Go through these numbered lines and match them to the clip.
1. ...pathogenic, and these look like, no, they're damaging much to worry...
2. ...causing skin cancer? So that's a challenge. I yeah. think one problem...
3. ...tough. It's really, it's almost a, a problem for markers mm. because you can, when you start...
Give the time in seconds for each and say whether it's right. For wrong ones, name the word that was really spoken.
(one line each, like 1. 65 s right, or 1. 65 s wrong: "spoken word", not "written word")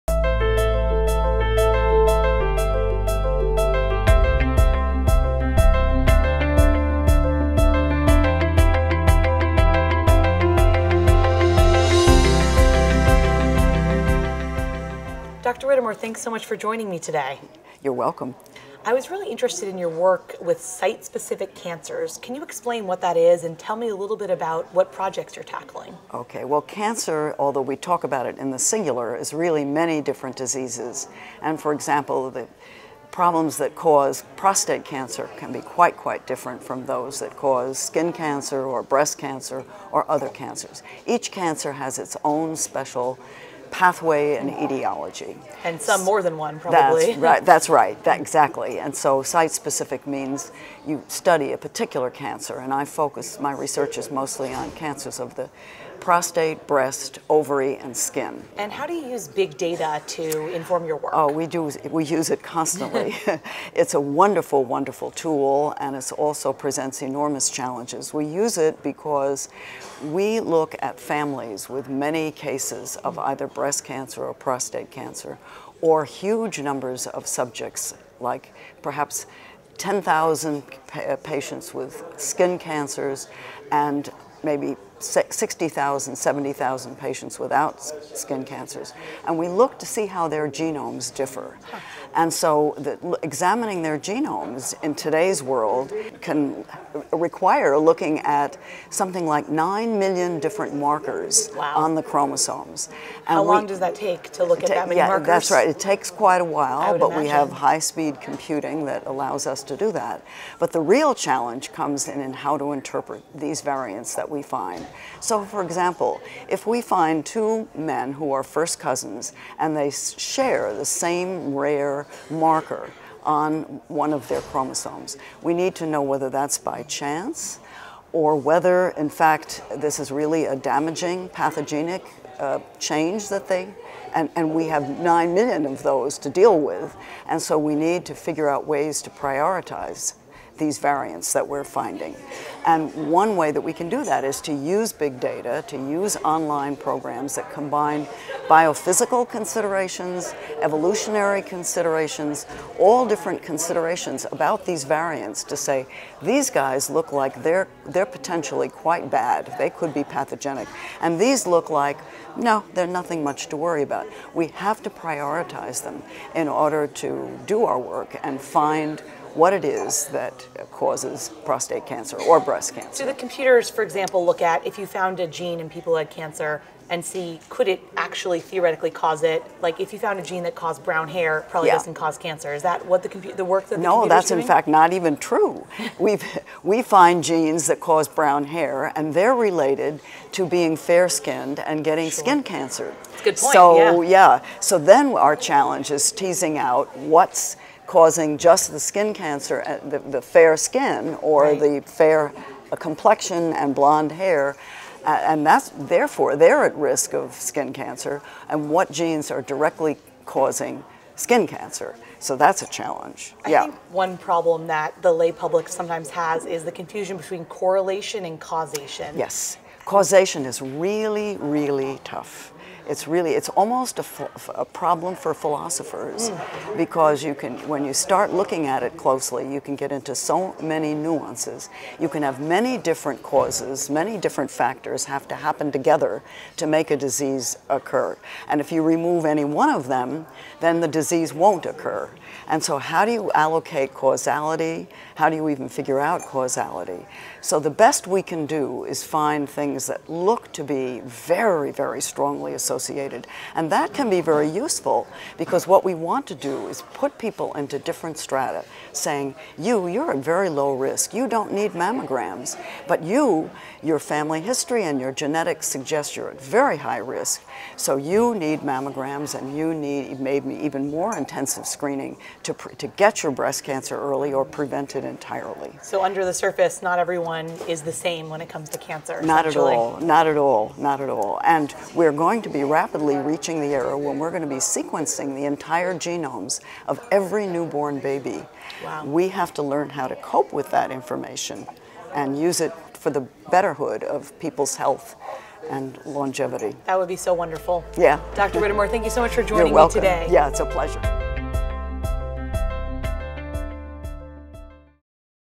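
1. 160 s wrong: "nothing", not "damaging"
2. 210 s right
3. 222 s wrong: "philosophers", not "markers".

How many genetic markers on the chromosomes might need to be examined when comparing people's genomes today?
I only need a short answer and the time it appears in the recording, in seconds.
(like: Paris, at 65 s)
9 million, at 99 s.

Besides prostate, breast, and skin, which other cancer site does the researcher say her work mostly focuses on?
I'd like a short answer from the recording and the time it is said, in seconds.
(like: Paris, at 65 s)
ovary, at 57 s.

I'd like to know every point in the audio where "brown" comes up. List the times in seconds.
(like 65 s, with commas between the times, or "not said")
180 s, 188 s.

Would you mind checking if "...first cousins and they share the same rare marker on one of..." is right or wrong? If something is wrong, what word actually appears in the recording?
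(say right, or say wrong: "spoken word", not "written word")
right.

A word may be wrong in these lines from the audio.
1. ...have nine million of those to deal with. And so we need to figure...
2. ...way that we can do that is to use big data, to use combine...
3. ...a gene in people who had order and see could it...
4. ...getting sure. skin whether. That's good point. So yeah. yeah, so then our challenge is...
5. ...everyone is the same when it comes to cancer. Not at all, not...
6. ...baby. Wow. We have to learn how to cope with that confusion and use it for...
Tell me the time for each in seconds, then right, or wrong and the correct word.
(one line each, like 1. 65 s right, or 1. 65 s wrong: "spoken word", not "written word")
1. 134 s right
2. 143 s wrong: "online", not "combine"
3. 175 s wrong: "cancer", not "order"
4. 191 s wrong: "cancer", not "whether"
5. 276 s right
6. 287 s wrong: "information", not "confusion".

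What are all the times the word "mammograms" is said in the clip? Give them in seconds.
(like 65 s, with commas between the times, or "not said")
261 s, 268 s.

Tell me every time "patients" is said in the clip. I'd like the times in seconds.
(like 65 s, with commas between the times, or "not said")
81 s, 86 s.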